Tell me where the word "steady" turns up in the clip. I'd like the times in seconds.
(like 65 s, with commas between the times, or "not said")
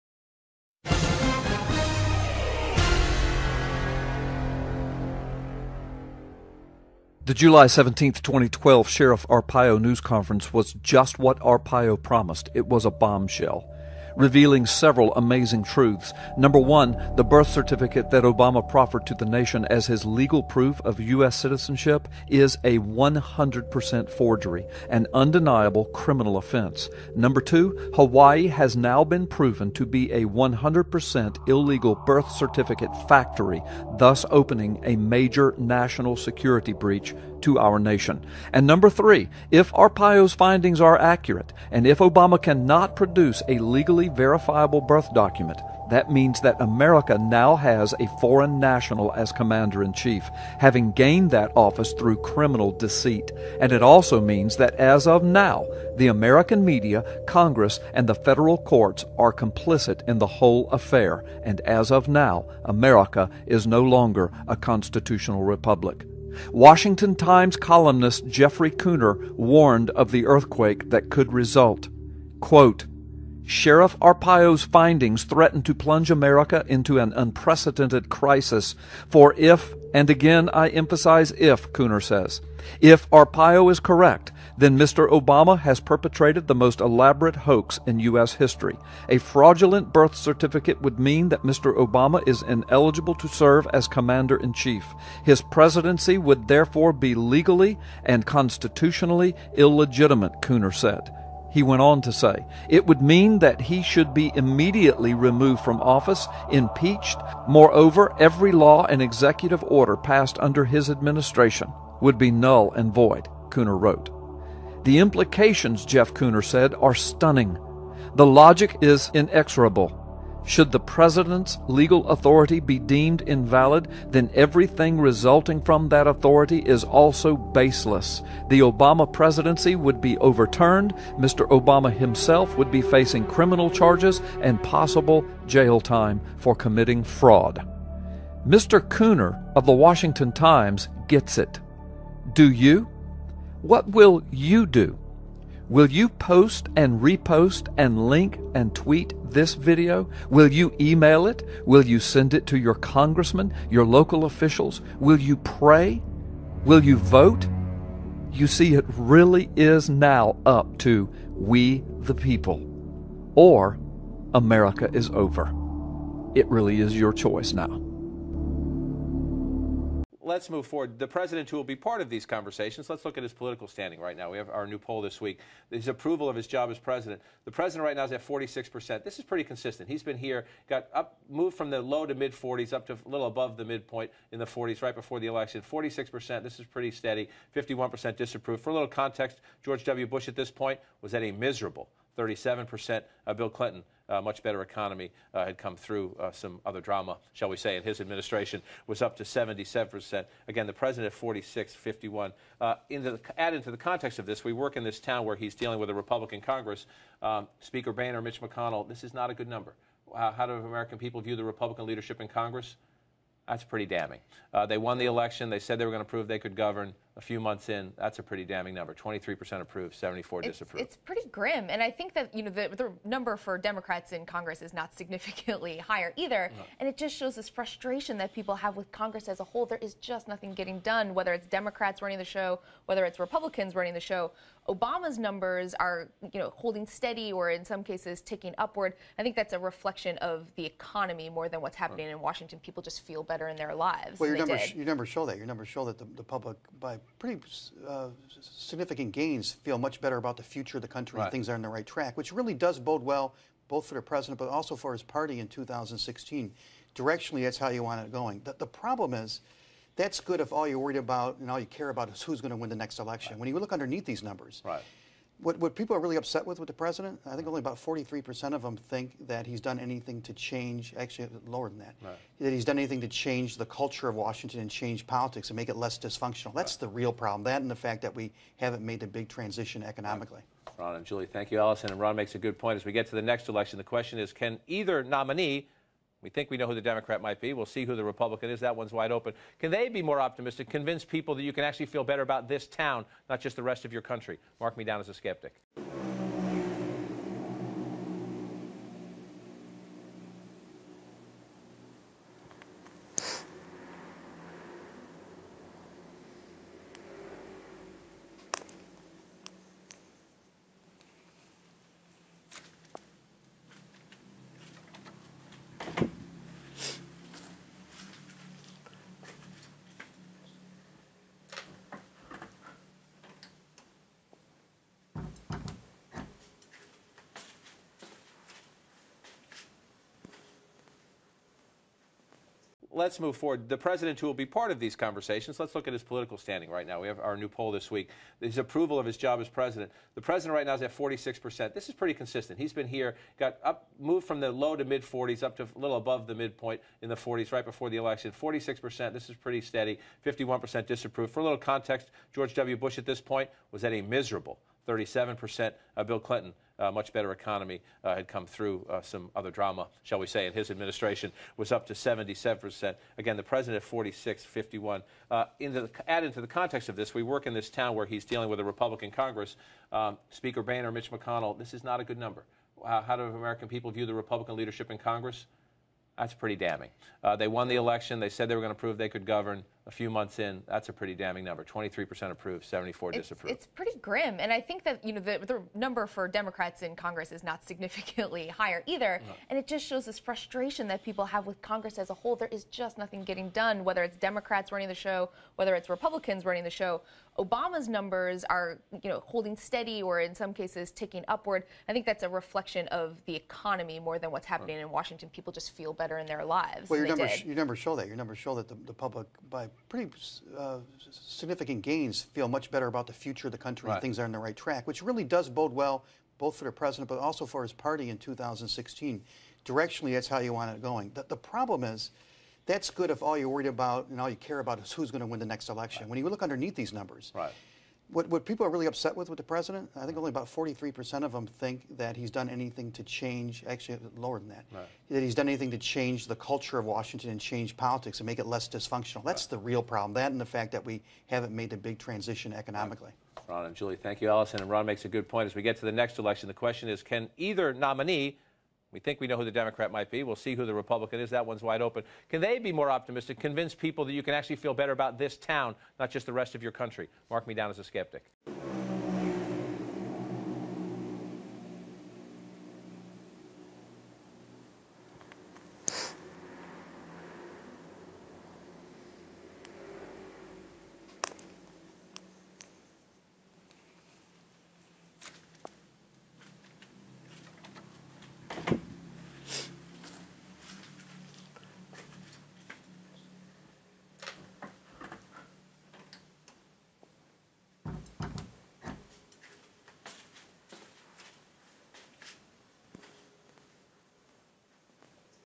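186 s, 236 s, 349 s, 399 s.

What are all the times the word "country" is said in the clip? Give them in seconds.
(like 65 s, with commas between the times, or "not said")
250 s, 294 s, 413 s, 456 s.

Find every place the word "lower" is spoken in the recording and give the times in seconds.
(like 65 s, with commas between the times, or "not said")
271 s, 434 s.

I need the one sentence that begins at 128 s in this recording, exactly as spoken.
The Obama presidency would be overturned, Mr.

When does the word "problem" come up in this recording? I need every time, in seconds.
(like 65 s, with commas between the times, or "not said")
258 s, 277 s, 421 s, 439 s.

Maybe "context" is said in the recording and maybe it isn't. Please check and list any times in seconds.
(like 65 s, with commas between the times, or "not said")
188 s, 203 s, 351 s, 366 s.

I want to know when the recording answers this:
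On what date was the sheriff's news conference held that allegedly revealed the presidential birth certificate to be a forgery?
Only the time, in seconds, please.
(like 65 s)
7 s.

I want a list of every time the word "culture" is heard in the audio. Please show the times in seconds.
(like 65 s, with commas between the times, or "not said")
273 s, 436 s.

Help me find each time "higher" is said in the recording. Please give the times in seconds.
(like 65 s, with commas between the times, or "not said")
225 s, 388 s.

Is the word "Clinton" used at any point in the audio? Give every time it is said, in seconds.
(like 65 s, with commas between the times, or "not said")
193 s, 356 s.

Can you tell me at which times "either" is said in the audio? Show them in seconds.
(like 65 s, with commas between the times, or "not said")
226 s, 284 s, 388 s, 447 s.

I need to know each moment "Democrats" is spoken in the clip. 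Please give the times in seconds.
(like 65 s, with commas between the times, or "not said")
223 s, 231 s, 286 s, 386 s, 394 s, 449 s.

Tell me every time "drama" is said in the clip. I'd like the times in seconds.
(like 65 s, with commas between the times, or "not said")
196 s, 359 s.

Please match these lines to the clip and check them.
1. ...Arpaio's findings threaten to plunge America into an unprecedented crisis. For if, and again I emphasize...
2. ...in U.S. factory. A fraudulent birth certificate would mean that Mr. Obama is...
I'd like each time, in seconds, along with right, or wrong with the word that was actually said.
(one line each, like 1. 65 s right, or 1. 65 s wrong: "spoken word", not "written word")
1. 73 s right
2. 87 s wrong: "history", not "factory".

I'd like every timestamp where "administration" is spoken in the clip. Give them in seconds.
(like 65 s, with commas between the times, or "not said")
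110 s, 198 s, 360 s.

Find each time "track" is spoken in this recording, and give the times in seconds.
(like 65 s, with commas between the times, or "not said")
251 s, 414 s.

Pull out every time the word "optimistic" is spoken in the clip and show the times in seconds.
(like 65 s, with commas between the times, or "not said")
290 s, 452 s.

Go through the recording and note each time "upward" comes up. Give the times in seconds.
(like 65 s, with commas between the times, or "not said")
238 s, 401 s.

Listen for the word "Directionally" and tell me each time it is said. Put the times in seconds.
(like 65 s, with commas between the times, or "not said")
256 s, 419 s.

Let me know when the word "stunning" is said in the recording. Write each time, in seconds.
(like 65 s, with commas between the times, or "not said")
116 s.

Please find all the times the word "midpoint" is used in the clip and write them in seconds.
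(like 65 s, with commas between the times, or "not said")
183 s, 346 s.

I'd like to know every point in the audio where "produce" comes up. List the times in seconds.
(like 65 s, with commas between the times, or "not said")
42 s.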